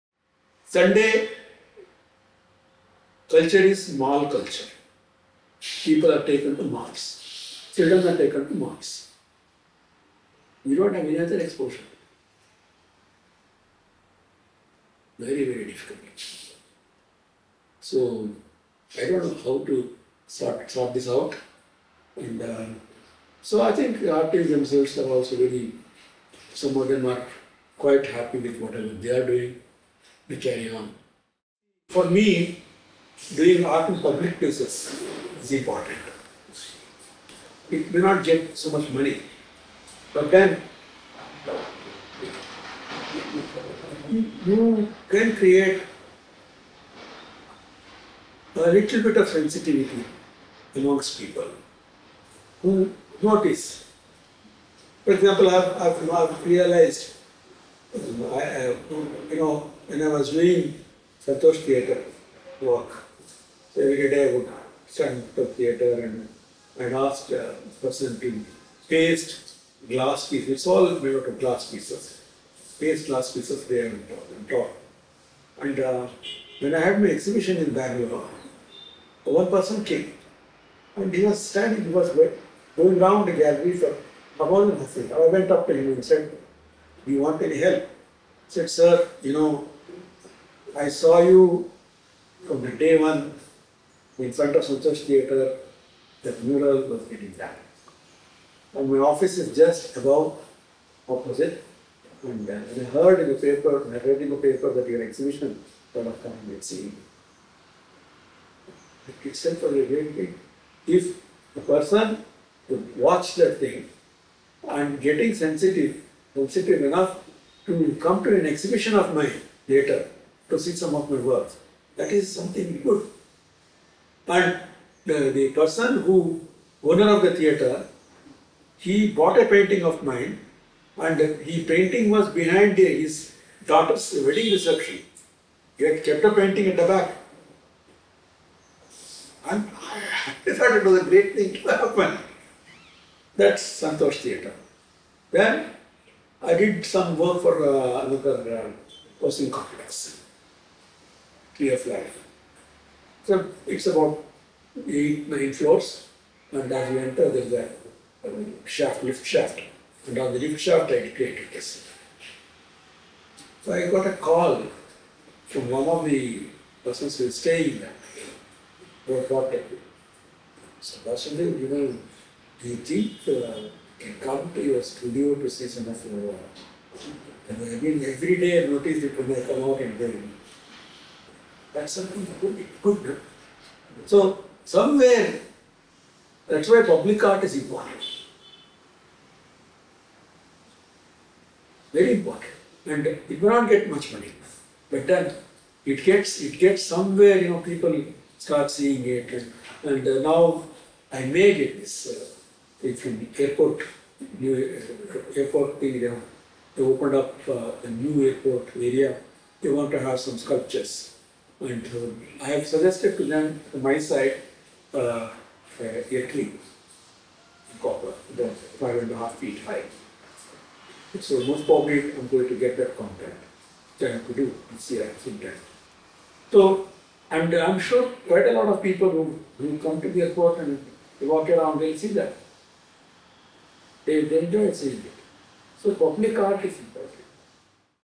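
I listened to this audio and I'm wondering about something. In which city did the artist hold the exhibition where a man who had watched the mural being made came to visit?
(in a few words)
Bangalore.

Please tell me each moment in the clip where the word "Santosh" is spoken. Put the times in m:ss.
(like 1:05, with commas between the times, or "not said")
1:01, 1:34, 2:23.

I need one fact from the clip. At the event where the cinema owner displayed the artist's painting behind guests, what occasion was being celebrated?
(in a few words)
daughter's wedding reception.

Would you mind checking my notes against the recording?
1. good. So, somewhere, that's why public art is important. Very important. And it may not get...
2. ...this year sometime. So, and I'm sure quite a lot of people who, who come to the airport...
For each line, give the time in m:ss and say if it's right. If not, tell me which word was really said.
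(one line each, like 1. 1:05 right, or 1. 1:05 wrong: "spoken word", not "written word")
1. 3:02 right
2. 3:44 right.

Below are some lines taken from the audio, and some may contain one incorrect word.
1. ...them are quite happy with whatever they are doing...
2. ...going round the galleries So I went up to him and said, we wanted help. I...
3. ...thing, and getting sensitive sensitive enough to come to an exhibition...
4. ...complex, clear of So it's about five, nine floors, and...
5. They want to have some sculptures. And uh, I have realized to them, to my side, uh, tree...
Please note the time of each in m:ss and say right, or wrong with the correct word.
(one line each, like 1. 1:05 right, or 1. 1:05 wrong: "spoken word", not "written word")
1. 0:26 right
2. 1:22 right
3. 1:53 right
4. 2:29 wrong: "eight", not "five"
5. 3:29 wrong: "suggested", not "realized".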